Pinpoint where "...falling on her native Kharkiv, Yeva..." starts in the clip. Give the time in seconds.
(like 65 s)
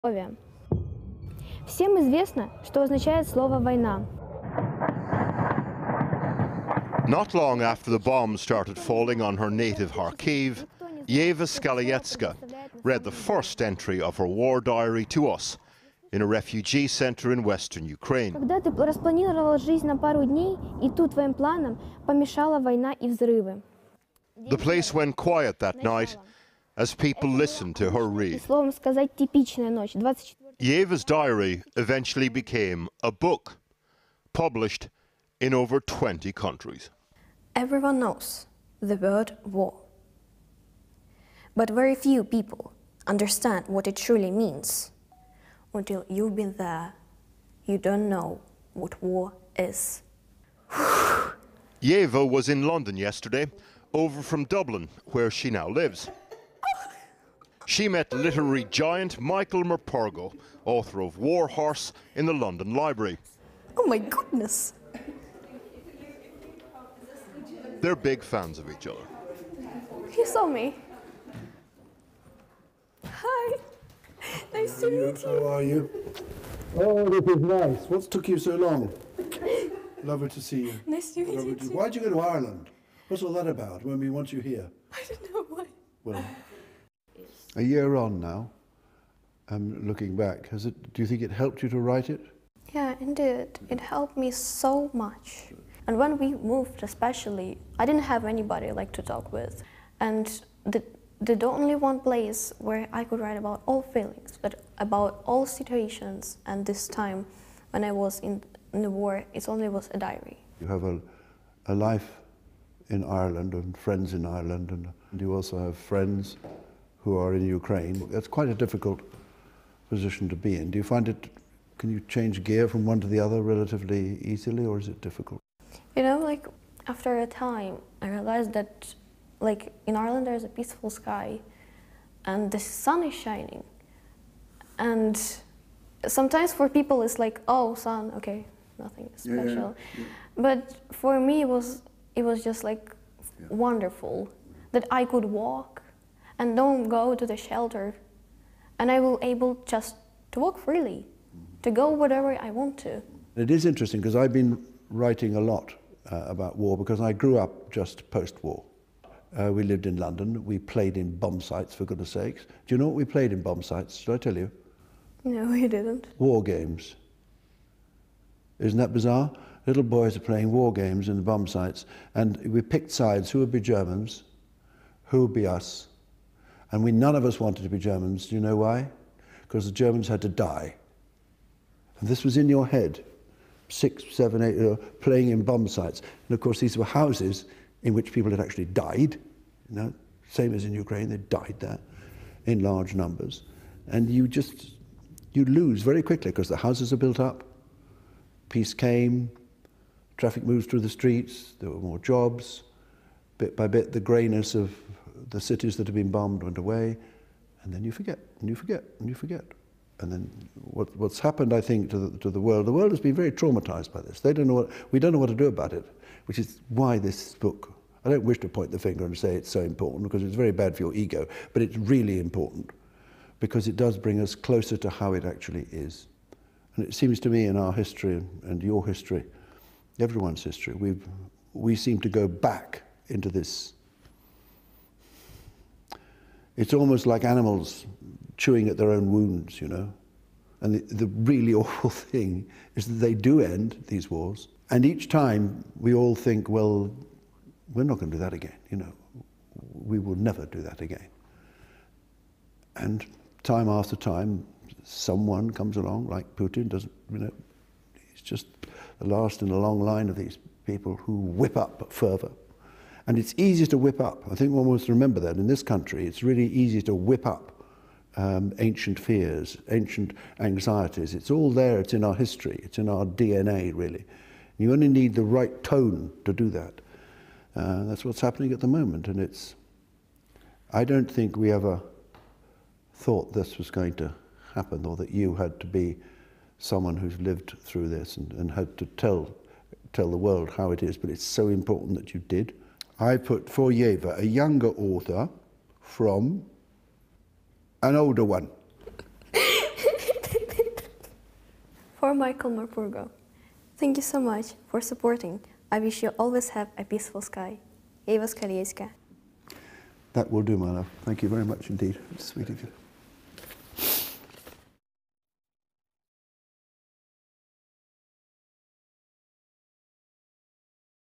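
8 s.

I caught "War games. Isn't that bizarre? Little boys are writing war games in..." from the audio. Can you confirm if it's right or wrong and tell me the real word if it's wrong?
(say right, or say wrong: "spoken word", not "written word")
wrong: "playing", not "writing".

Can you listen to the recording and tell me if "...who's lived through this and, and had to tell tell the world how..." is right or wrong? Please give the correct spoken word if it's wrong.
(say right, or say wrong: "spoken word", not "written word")
right.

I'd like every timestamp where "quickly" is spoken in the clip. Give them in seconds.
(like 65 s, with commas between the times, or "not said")
196 s.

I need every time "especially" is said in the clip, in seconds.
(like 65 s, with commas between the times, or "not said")
96 s.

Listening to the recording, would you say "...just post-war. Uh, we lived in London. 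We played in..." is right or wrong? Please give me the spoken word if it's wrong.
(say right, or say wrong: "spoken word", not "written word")
right.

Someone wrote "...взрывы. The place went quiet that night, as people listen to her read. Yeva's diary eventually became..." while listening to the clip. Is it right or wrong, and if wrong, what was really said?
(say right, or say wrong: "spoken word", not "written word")
right.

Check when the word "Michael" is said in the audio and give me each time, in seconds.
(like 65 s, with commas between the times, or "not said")
59 s, 302 s.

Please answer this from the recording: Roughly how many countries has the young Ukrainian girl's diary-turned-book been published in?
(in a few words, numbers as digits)
over 20.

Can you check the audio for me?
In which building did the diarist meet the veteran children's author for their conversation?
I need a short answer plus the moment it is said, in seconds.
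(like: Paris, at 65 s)
London Library, at 62 s.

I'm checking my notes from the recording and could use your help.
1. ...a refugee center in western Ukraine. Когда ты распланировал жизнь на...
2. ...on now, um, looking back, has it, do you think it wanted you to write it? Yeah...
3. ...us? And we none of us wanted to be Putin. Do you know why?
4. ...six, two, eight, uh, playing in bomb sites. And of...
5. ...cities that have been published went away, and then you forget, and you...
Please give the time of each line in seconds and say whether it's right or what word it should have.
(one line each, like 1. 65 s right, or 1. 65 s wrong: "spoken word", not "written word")
1. 16 s right
2. 87 s wrong: "helped", not "wanted"
3. 175 s wrong: "Germans", not "Putin"
4. 183 s wrong: "seven", not "two"
5. 205 s wrong: "bombed", not "published".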